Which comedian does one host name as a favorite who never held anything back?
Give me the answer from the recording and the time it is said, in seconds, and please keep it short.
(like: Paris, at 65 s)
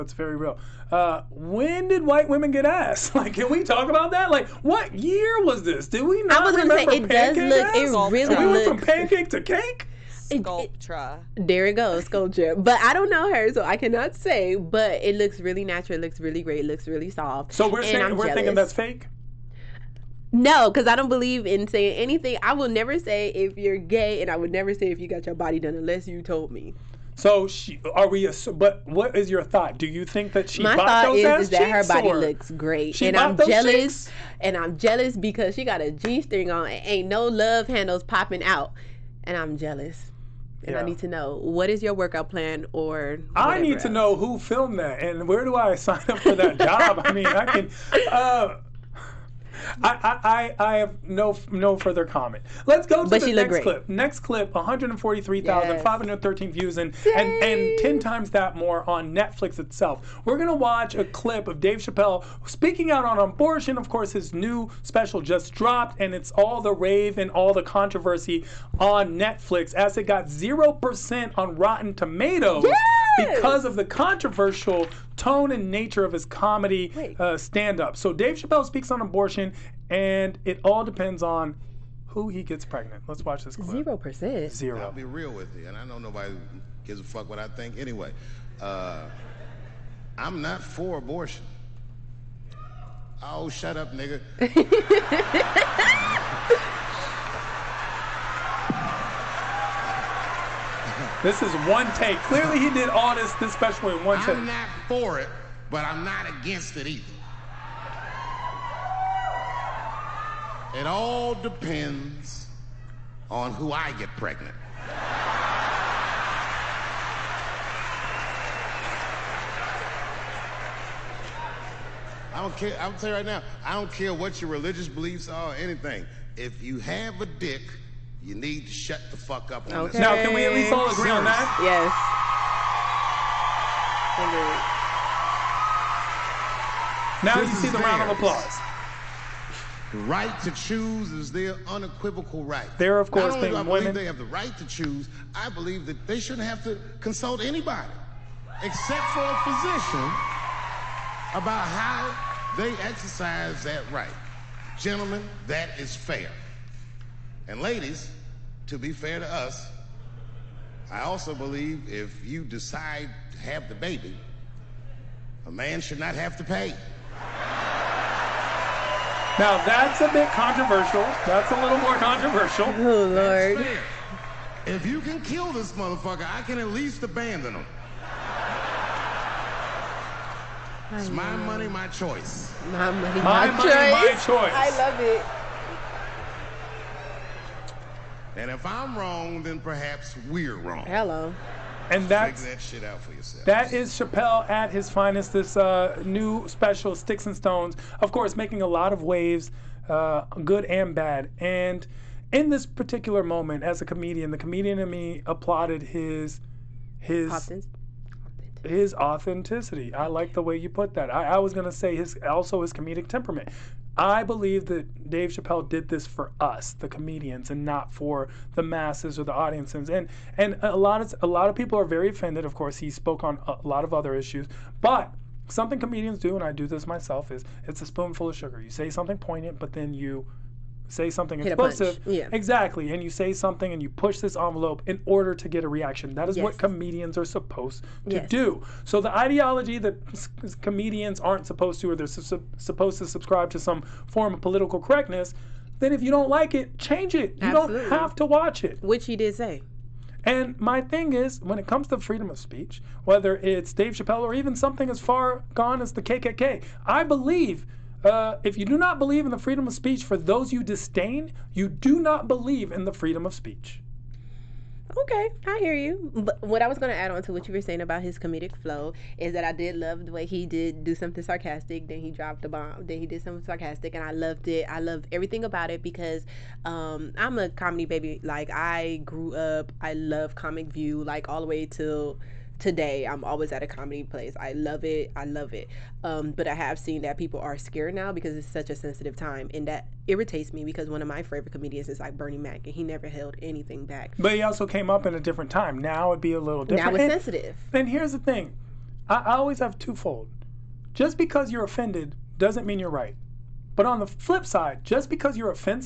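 Bernie Mac, at 292 s.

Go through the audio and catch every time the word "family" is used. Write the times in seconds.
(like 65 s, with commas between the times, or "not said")
not said.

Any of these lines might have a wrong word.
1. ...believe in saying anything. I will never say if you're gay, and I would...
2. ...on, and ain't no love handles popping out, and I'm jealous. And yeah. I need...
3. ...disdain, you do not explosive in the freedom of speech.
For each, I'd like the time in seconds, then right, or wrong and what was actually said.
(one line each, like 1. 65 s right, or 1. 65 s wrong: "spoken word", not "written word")
1. 21 s right
2. 36 s right
3. 260 s wrong: "believe", not "explosive".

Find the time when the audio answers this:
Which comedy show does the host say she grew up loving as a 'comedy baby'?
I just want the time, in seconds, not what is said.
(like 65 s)
280 s.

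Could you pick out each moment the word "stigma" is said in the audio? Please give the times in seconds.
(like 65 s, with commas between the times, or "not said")
not said.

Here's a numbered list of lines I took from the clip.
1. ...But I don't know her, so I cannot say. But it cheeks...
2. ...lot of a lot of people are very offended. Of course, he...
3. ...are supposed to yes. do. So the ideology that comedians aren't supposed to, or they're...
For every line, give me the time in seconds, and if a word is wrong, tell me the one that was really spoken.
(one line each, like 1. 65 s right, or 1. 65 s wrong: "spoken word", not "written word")
1. 12 s wrong: "looks", not "cheeks"
2. 220 s right
3. 237 s right.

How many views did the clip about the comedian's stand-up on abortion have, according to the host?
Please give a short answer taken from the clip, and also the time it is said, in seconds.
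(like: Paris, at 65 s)
143,513, at 54 s.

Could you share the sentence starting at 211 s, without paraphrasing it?
I, I was gonna say his also his comedic temperament.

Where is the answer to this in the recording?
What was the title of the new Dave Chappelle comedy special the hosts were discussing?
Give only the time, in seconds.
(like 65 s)
196 s.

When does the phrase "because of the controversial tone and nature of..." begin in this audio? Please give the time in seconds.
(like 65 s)
73 s.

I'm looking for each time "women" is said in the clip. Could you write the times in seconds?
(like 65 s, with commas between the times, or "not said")
2 s, 143 s.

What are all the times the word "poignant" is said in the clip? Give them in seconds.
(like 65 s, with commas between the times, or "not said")
229 s.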